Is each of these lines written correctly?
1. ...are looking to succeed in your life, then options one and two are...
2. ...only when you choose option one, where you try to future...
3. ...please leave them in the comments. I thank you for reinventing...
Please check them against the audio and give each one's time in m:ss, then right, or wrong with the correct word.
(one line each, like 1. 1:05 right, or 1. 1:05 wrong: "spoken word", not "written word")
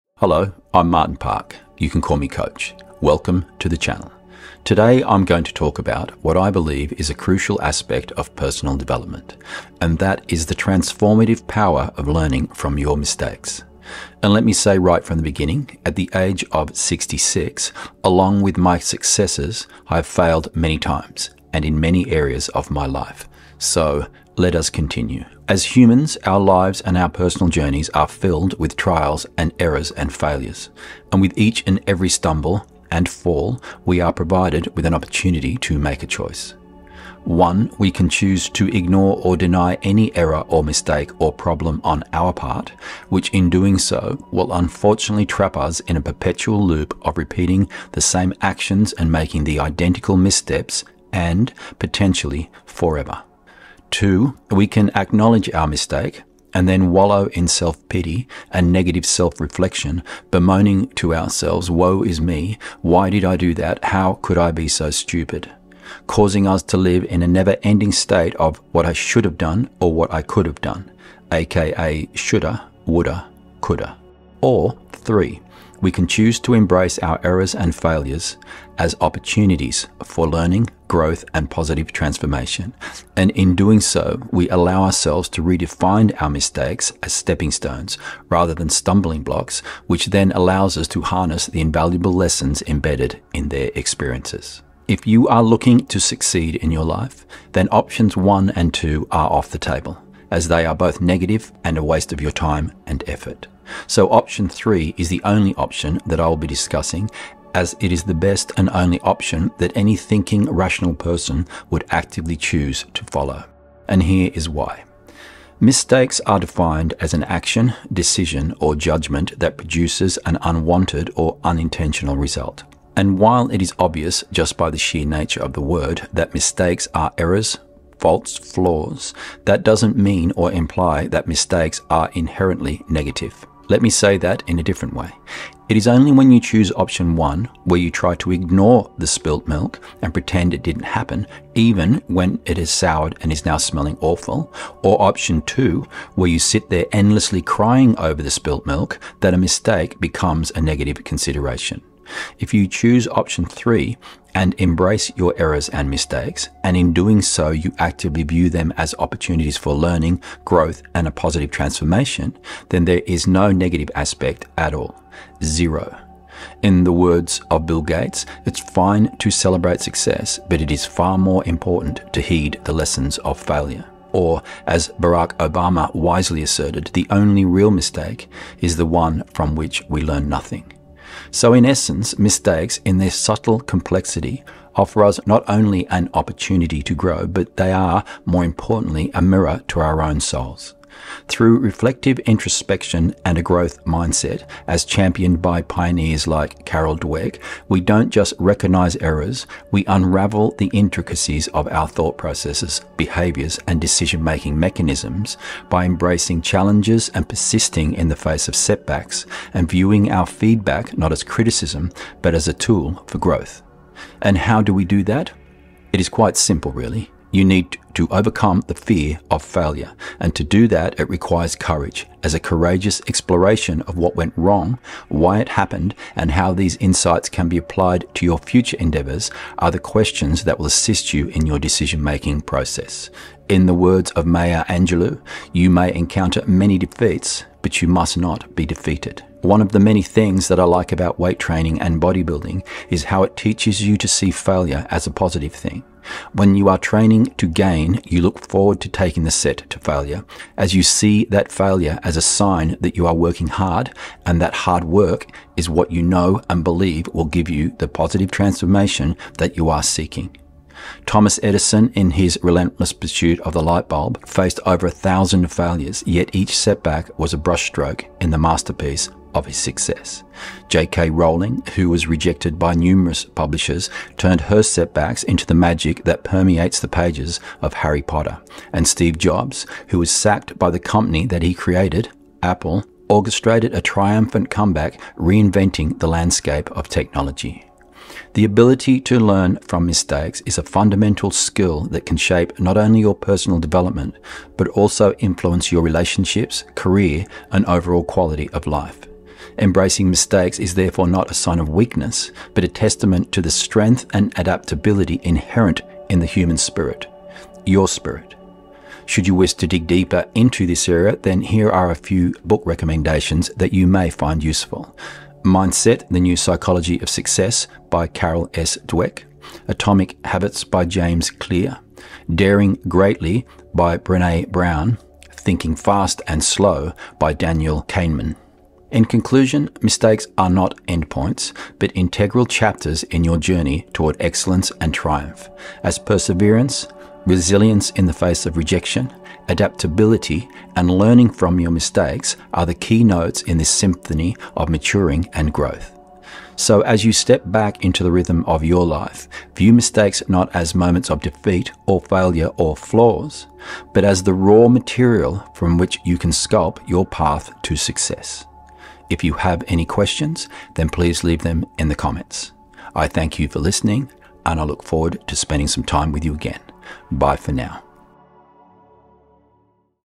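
1. 1:35 right
2. 2:15 wrong: "ignore", not "future"
3. 6:00 wrong: "listening", not "reinventing".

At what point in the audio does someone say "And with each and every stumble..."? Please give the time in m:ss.
0:31.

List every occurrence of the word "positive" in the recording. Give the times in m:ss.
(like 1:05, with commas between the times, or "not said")
1:21, 2:41, 4:05, 4:17.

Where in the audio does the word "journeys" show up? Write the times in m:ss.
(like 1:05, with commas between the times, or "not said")
0:27, 5:33.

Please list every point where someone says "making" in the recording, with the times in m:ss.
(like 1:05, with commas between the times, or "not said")
0:49, 3:24, 3:52.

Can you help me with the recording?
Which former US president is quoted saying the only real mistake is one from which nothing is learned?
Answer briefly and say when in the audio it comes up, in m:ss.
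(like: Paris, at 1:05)
Barack Obama, at 2:54.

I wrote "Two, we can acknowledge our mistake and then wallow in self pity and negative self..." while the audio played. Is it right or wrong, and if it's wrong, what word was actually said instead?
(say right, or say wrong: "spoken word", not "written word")
right.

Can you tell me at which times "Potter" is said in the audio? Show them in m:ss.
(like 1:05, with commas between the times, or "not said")
4:38.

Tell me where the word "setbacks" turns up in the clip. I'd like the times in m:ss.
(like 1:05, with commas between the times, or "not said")
3:28, 4:26, 4:34.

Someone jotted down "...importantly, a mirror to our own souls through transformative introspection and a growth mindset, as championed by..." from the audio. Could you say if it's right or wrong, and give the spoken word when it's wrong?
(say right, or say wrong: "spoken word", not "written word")
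wrong: "reflective", not "transformative".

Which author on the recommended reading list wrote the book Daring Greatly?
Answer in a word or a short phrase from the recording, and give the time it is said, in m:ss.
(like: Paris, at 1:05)
Brene Brown, at 5:23.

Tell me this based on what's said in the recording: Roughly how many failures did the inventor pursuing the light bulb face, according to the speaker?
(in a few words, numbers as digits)
over 1000.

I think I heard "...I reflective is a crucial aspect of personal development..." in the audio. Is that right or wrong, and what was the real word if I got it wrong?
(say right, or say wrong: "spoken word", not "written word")
wrong: "believe", not "reflective".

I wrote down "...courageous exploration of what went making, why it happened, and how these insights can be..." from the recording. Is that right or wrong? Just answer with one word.
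wrong.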